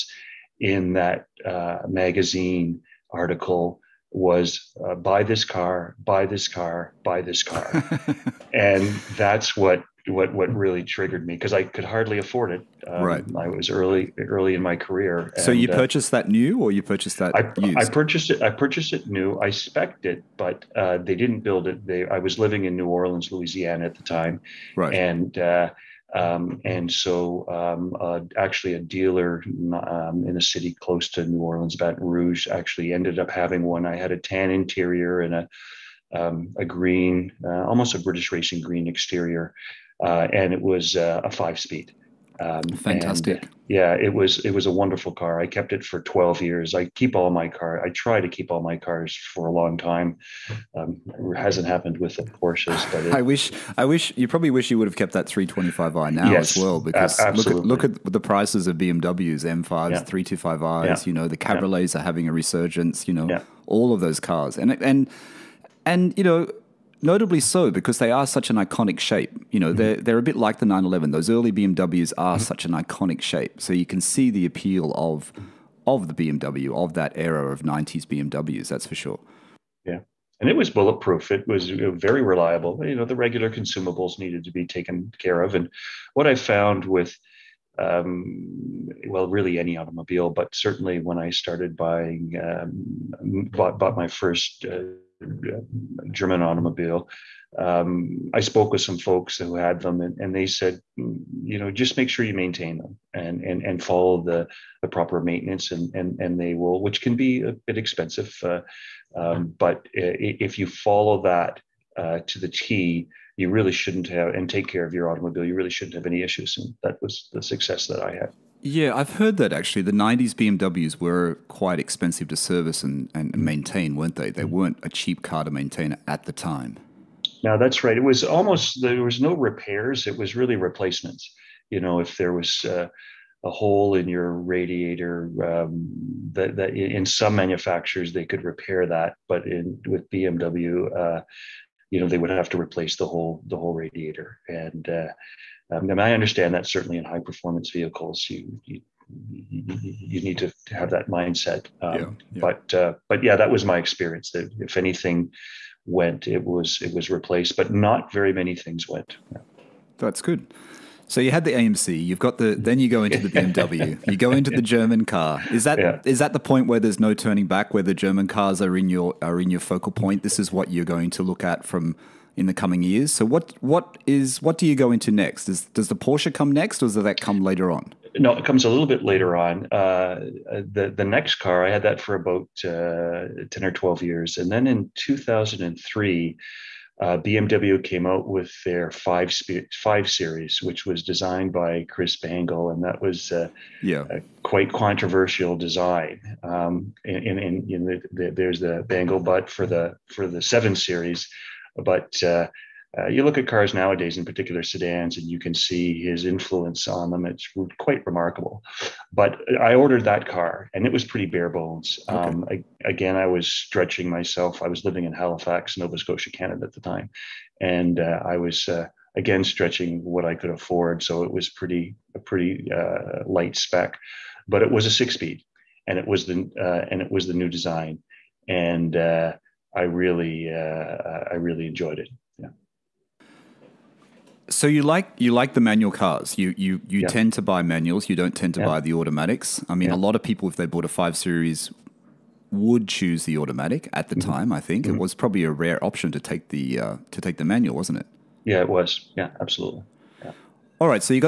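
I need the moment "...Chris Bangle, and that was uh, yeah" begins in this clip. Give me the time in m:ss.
3:11.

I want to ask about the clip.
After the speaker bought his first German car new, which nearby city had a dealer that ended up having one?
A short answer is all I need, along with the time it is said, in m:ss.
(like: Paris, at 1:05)
Baton Rouge, at 0:31.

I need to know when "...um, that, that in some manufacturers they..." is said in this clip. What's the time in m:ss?
2:15.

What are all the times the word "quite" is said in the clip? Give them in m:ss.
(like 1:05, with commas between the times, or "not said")
2:01, 3:14, 3:27.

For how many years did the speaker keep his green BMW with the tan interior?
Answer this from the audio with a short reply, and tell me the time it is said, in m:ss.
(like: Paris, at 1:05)
12, at 0:46.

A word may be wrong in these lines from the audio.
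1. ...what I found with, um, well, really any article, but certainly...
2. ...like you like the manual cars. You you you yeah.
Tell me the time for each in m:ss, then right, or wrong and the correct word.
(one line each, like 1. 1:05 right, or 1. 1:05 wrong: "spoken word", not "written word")
1. 1:26 wrong: "automobile", not "article"
2. 3:54 right.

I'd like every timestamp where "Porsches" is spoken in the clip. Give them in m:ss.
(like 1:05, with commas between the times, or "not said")
0:52, 2:55.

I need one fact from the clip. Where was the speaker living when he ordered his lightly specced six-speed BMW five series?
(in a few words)
Halifax, Nova Scotia.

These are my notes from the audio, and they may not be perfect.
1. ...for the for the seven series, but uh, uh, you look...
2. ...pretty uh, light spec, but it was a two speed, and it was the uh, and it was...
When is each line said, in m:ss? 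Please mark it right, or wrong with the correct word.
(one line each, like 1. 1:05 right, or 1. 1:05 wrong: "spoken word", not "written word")
1. 3:19 right
2. 3:42 wrong: "six", not "two".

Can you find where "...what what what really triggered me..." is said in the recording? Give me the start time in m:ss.
0:09.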